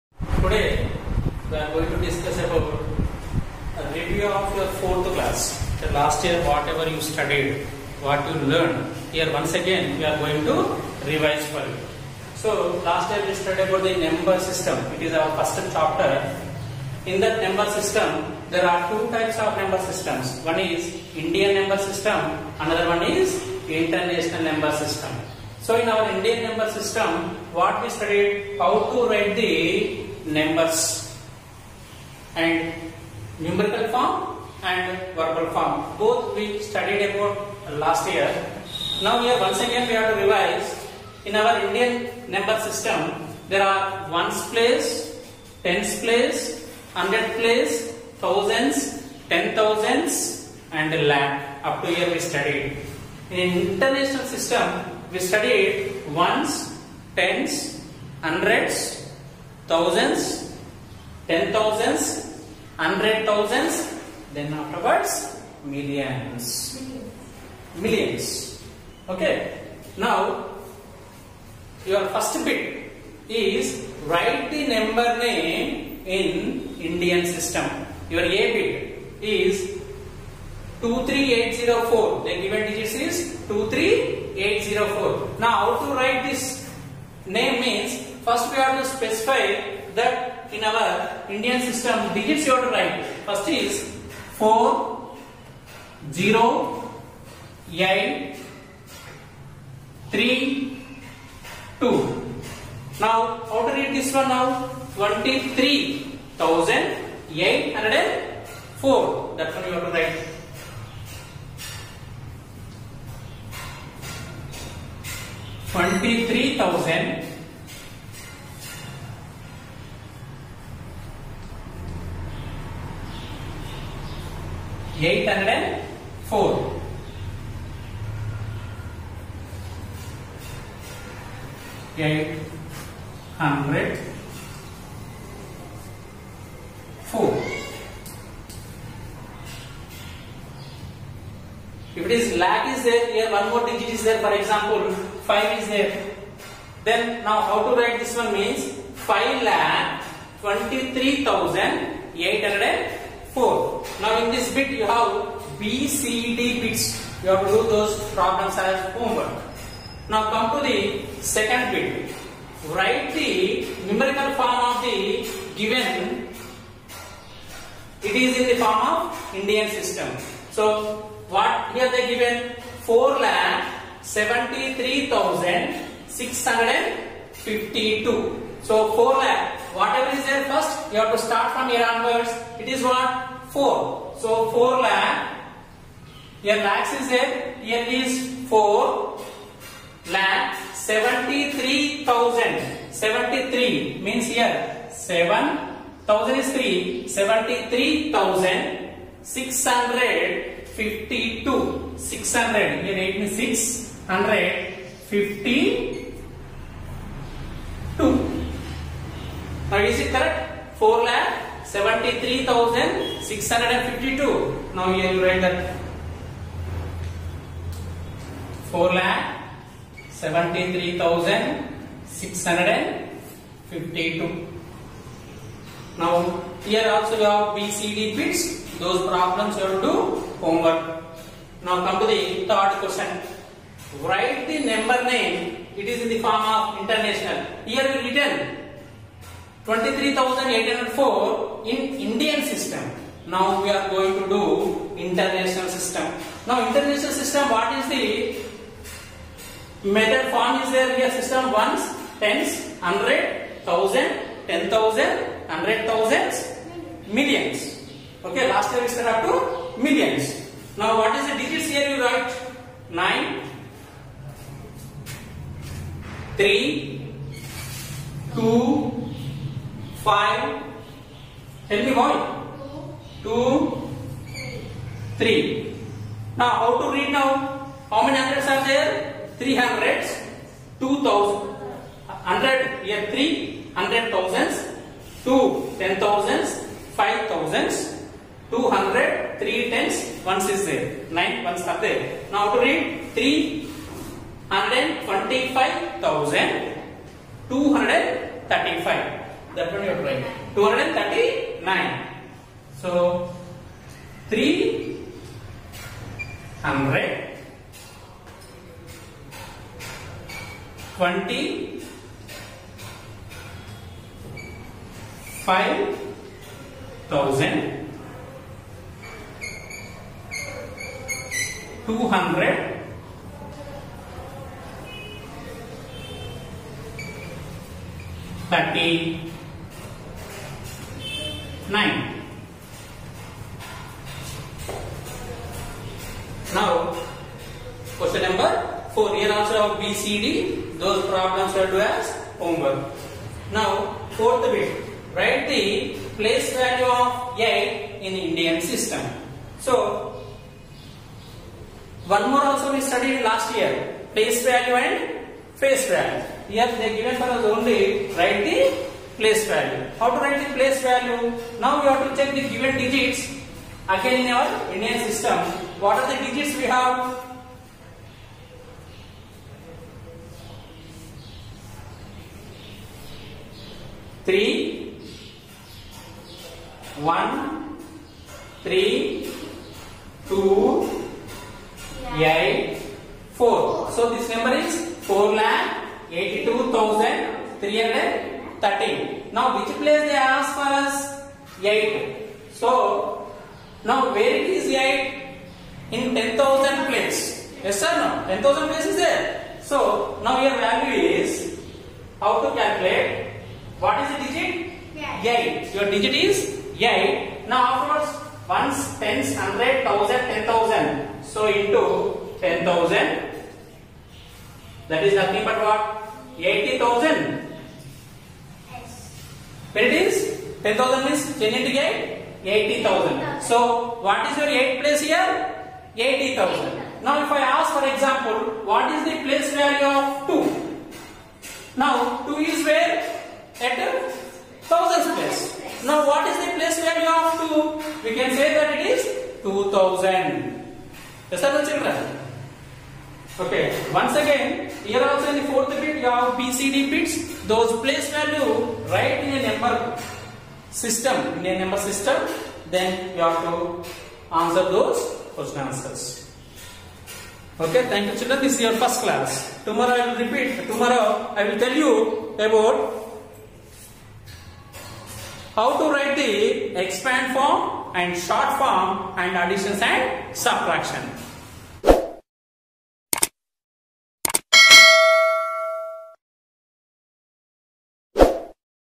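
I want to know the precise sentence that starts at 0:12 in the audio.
So last year we studied about the number system.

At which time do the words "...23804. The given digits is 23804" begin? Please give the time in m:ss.
1:20.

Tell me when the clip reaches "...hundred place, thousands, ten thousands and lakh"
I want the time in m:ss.
0:46.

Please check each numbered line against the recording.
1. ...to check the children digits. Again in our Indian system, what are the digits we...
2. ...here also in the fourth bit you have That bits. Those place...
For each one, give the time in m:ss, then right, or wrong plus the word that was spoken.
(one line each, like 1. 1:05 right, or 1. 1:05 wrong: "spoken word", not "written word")
1. 6:02 wrong: "given", not "children"
2. 7:24 wrong: "PCD", not "That".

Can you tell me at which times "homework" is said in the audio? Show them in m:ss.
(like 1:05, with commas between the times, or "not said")
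2:38, 3:50, 5:42.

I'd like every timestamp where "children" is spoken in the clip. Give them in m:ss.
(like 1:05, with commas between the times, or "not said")
7:21, 7:38.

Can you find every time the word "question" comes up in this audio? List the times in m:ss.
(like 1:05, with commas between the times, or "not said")
3:52, 5:37.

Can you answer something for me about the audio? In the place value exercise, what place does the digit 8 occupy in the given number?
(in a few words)
10,000 place.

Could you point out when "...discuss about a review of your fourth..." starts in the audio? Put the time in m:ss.
0:02.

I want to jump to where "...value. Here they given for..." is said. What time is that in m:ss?
5:55.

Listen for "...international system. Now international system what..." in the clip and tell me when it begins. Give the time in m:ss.
4:04.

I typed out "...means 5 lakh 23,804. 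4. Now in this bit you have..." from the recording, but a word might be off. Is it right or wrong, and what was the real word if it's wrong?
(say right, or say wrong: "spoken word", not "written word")
right.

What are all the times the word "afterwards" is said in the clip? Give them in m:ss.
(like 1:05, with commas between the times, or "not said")
1:04, 6:47.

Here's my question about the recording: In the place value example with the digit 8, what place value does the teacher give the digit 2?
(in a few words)
2000.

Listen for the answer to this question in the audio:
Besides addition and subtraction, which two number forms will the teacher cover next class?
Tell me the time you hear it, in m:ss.
7:46.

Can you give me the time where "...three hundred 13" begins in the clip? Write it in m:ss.
6:27.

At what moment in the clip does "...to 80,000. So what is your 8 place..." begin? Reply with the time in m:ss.
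7:02.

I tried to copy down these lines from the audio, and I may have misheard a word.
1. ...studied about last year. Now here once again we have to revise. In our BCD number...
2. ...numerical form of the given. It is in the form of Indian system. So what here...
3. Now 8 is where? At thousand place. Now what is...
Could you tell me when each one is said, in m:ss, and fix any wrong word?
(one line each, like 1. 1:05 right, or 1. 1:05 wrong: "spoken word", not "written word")
1. 0:36 wrong: "Indian", not "BCD"
2. 2:43 right
3. 7:11 wrong: "2", not "8".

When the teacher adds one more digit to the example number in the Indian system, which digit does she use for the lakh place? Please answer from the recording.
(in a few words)
5.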